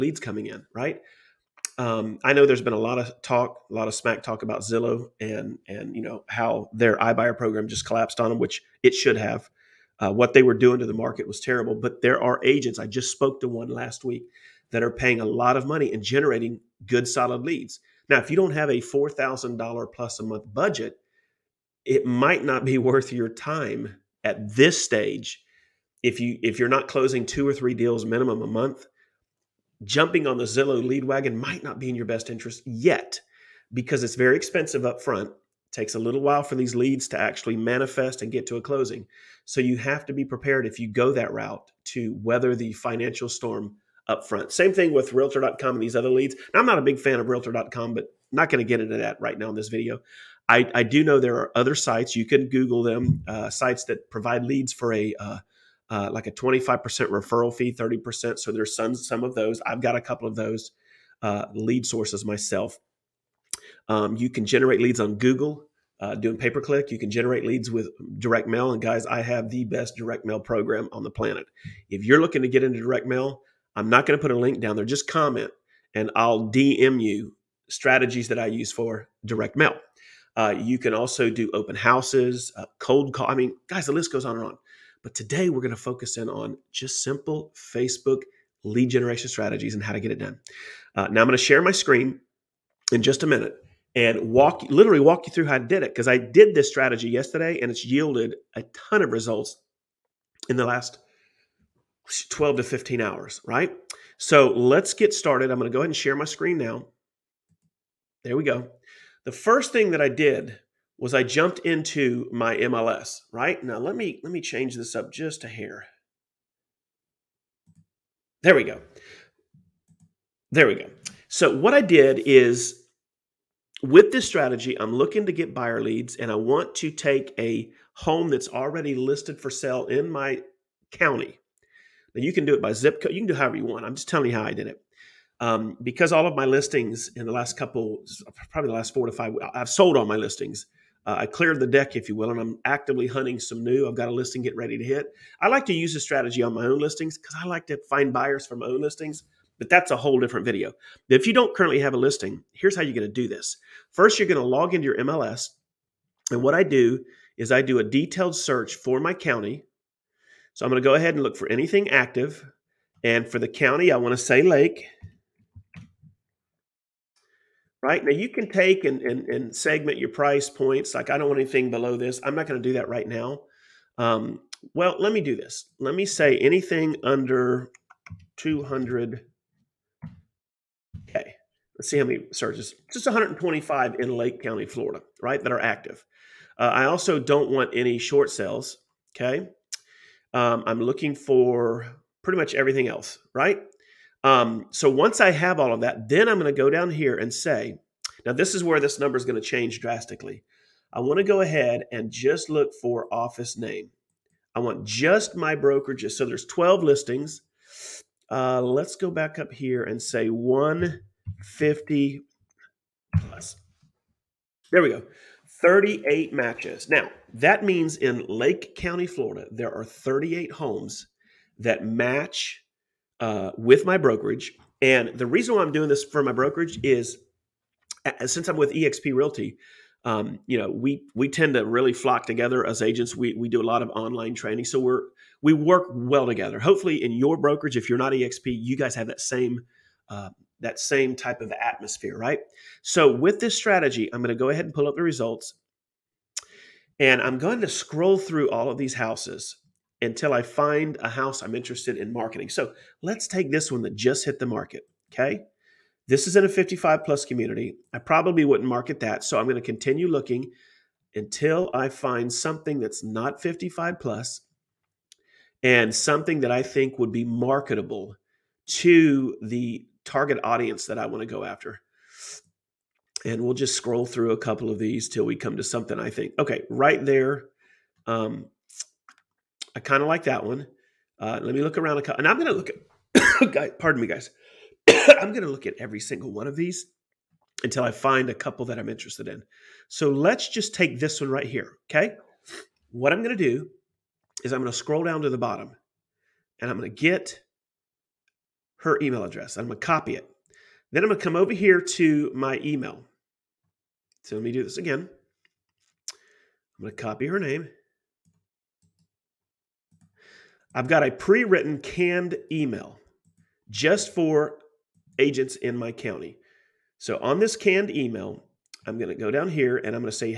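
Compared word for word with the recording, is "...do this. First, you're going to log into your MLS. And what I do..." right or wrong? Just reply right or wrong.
right.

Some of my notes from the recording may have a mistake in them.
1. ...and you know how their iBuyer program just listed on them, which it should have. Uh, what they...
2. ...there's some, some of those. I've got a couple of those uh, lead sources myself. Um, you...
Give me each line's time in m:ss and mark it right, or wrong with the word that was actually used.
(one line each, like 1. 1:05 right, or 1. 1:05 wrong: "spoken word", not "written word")
1. 0:05 wrong: "collapsed", not "listed"
2. 0:58 right.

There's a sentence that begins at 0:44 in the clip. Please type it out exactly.
Same thing with realtor.com and these other leads.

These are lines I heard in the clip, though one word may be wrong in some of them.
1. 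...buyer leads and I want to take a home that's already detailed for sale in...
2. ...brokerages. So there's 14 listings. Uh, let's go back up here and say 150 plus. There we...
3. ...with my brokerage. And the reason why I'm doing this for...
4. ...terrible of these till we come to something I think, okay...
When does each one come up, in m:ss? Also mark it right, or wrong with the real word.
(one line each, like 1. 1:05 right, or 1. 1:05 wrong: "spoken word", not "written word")
1. 2:05 wrong: "listed", not "detailed"
2. 3:25 wrong: "12", not "14"
3. 3:43 right
4. 4:34 wrong: "couple", not "terrible".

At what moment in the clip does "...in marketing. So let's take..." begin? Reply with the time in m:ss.
4:11.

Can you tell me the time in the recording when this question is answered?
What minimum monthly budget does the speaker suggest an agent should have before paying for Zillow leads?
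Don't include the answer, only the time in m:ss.
0:18.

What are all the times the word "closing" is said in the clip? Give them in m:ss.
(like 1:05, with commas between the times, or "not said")
0:26, 0:38.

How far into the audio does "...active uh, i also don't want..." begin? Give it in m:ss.
3:05.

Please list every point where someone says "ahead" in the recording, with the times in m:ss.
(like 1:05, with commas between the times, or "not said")
1:45, 2:40, 3:21, 4:04.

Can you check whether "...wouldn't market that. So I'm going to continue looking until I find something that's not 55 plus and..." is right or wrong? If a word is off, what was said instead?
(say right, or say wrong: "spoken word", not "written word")
right.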